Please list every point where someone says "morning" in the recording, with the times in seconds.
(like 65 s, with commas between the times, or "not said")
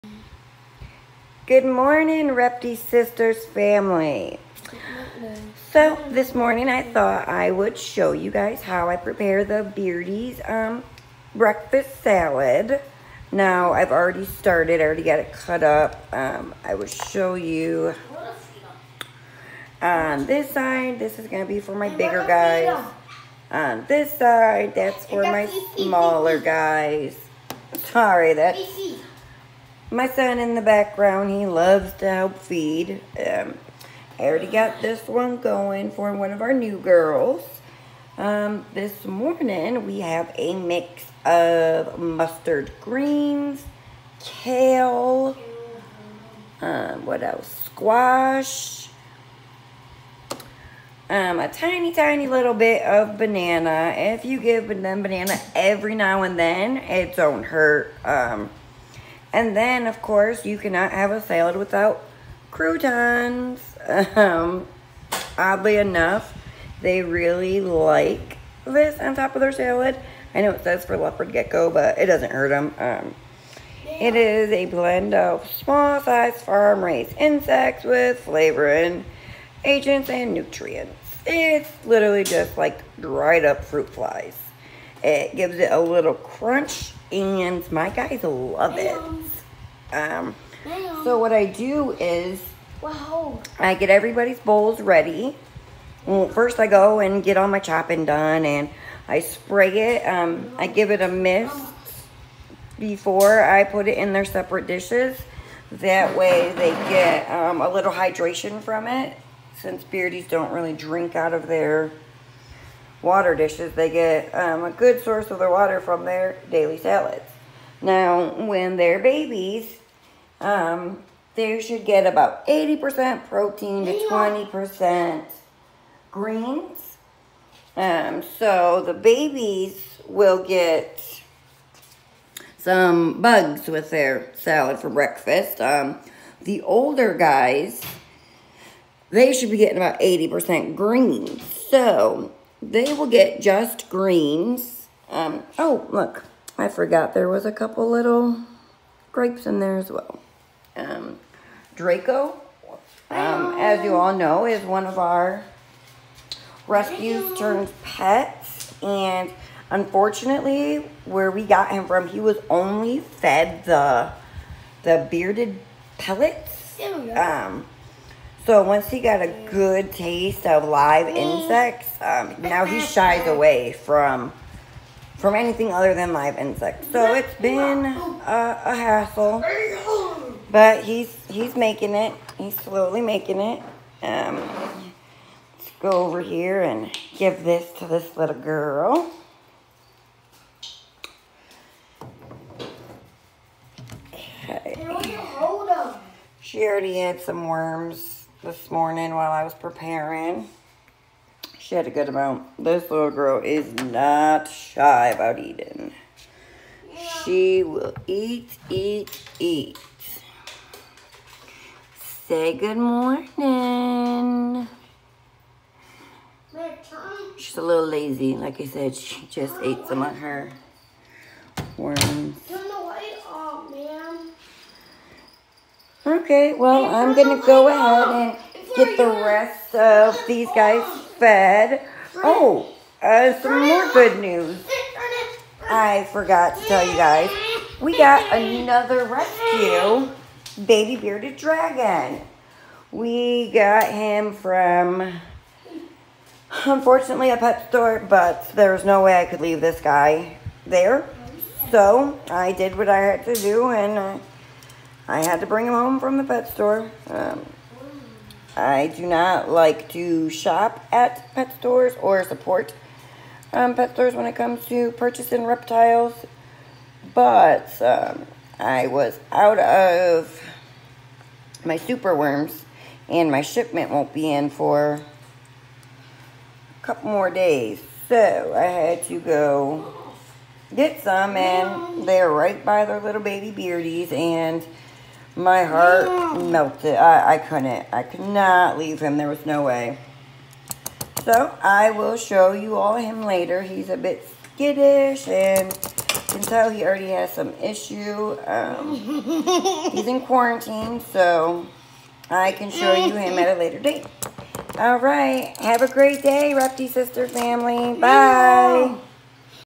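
1 s, 6 s, 39 s, 198 s, 212 s.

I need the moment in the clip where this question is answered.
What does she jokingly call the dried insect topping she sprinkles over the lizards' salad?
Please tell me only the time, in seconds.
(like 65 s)
62 s.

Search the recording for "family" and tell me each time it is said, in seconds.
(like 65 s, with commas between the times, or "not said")
3 s, 307 s.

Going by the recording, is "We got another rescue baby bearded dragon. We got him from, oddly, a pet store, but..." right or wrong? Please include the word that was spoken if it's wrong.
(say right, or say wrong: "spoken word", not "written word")
wrong: "unfortunately", not "oddly".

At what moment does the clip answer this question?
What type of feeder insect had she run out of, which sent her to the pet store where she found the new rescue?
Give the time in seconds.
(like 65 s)
271 s.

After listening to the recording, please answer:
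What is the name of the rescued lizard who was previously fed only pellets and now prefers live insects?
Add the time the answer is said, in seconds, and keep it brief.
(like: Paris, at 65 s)
Draco, at 151 s.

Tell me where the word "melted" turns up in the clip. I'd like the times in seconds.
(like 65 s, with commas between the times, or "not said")
286 s.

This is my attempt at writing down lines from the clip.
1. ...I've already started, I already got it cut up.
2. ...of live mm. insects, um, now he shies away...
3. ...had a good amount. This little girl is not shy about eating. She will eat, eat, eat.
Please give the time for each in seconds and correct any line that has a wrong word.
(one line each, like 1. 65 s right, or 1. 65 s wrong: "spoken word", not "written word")
1. 13 s right
2. 170 s right
3. 201 s right.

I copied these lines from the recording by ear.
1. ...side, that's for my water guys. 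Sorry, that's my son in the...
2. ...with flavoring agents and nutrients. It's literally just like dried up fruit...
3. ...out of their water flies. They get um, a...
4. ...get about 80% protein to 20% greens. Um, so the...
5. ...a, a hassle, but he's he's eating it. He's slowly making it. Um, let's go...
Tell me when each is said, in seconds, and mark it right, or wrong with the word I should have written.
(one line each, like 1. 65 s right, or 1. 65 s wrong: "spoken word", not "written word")
1. 24 s wrong: "smaller", not "water"
2. 77 s right
3. 111 s wrong: "dishes", not "flies"
4. 121 s right
5. 177 s wrong: "making", not "eating".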